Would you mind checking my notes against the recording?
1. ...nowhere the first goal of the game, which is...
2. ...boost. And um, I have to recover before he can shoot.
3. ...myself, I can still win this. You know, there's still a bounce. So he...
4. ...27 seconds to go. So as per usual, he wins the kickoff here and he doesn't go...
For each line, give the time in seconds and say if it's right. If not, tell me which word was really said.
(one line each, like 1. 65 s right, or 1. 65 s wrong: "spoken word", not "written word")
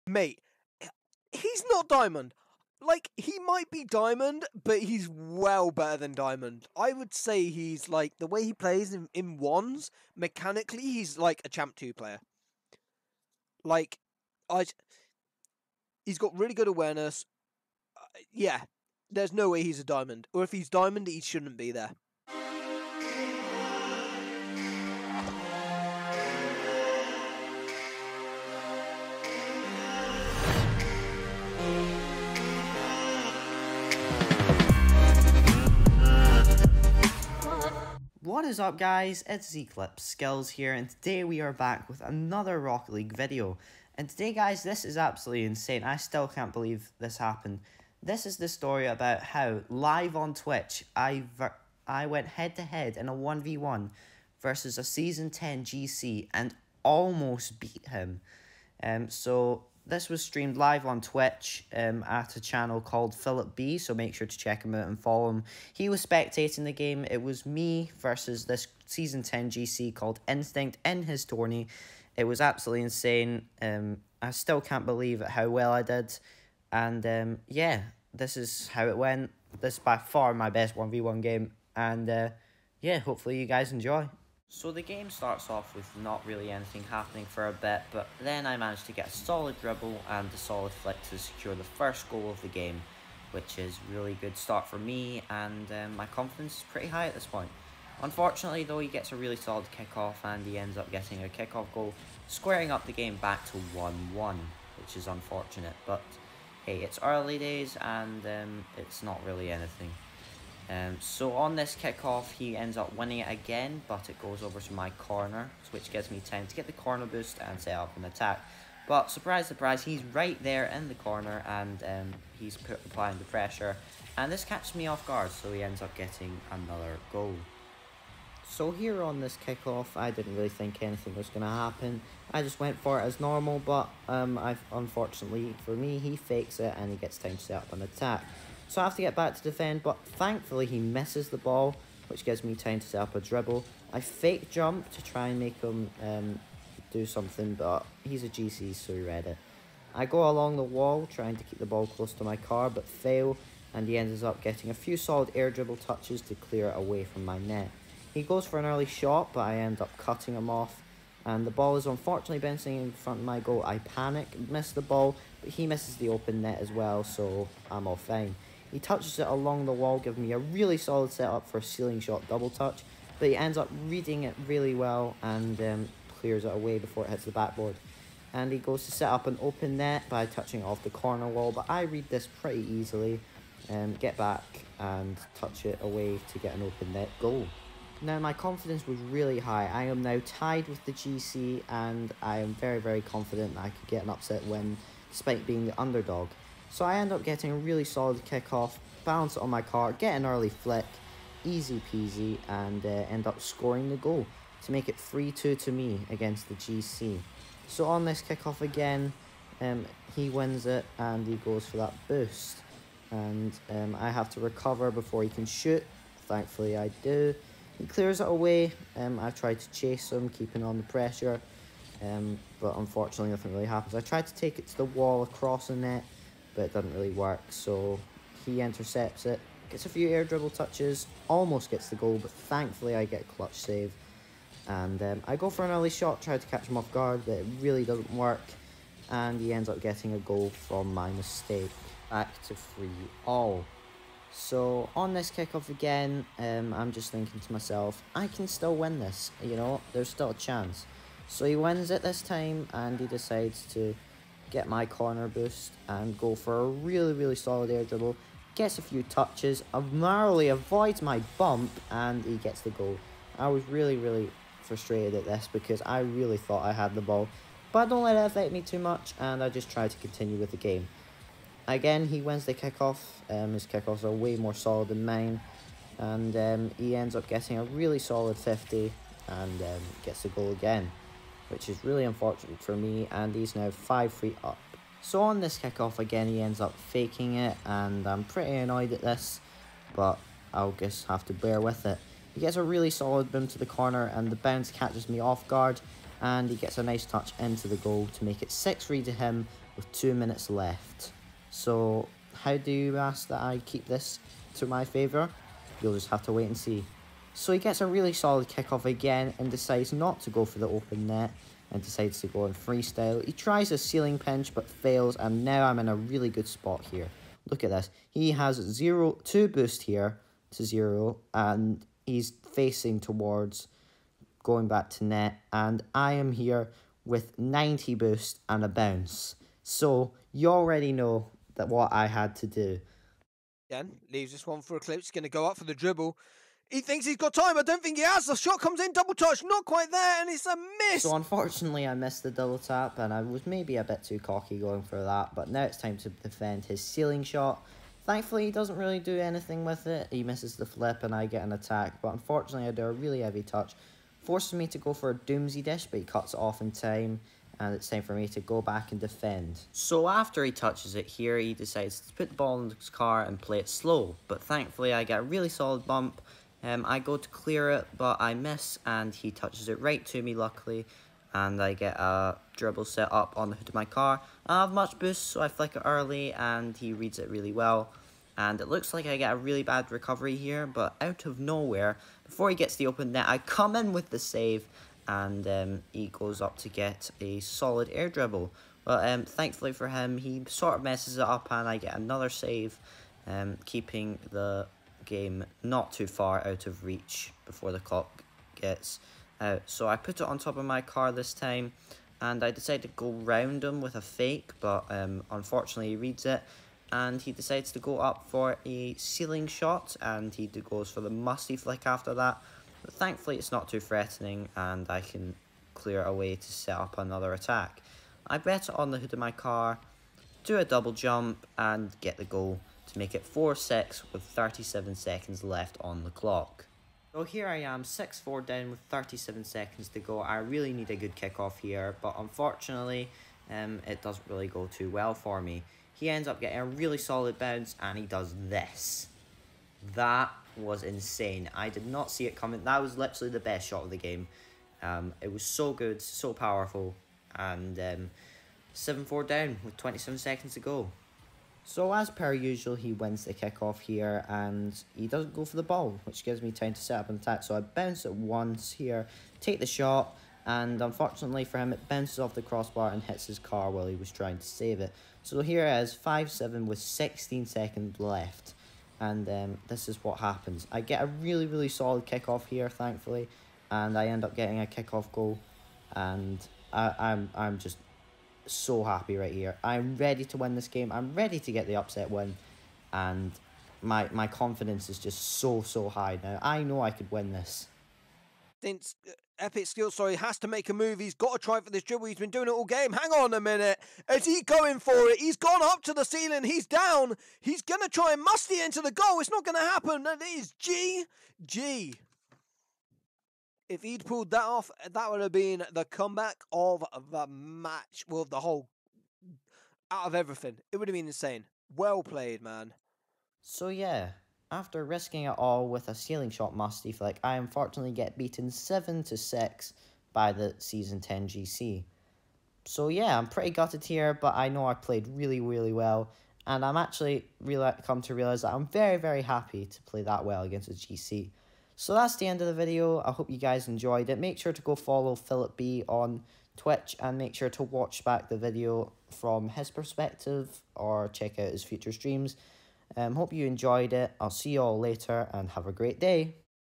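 1. 91 s wrong: "secure", not "nowhere"
2. 212 s right
3. 247 s wrong: "chance", not "bounce"
4. 449 s right.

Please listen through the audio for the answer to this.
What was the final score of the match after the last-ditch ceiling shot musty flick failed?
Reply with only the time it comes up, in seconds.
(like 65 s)
518 s.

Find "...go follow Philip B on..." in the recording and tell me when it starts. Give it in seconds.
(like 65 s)
534 s.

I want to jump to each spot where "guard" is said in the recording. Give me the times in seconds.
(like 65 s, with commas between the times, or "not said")
125 s, 236 s, 295 s.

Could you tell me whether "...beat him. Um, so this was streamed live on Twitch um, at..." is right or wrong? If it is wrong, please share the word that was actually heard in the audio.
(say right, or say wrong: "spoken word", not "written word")
right.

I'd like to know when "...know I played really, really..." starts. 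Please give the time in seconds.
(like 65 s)
524 s.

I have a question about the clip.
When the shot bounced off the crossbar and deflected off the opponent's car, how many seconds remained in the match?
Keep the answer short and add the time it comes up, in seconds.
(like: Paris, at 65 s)
16, at 466 s.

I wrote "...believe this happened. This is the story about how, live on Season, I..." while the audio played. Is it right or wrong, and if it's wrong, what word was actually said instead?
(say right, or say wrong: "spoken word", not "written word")
wrong: "Twitch", not "Season".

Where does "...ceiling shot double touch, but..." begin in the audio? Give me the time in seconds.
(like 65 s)
171 s.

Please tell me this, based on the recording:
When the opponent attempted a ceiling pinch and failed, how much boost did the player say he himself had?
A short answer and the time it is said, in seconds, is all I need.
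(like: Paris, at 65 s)
90, at 327 s.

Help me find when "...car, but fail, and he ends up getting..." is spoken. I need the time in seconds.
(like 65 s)
152 s.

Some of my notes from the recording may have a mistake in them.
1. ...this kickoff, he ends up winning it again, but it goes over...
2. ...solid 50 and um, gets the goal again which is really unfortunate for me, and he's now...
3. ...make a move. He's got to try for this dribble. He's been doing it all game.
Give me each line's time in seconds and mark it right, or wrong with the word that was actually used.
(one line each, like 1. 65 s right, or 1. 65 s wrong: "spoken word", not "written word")
1. 111 s right
2. 277 s right
3. 490 s right.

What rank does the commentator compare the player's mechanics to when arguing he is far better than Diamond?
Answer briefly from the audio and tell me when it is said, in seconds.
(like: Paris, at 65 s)
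Champ 2, at 11 s.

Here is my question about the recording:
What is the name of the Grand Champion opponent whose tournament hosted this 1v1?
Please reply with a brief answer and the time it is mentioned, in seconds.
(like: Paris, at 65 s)
Instinct, at 70 s.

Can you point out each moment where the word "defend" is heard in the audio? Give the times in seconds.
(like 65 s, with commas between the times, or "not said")
139 s, 346 s, 358 s.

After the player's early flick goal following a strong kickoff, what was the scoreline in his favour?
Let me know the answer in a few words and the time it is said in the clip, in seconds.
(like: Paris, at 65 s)
3-2, at 204 s.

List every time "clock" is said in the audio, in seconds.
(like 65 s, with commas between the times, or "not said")
397 s, 426 s.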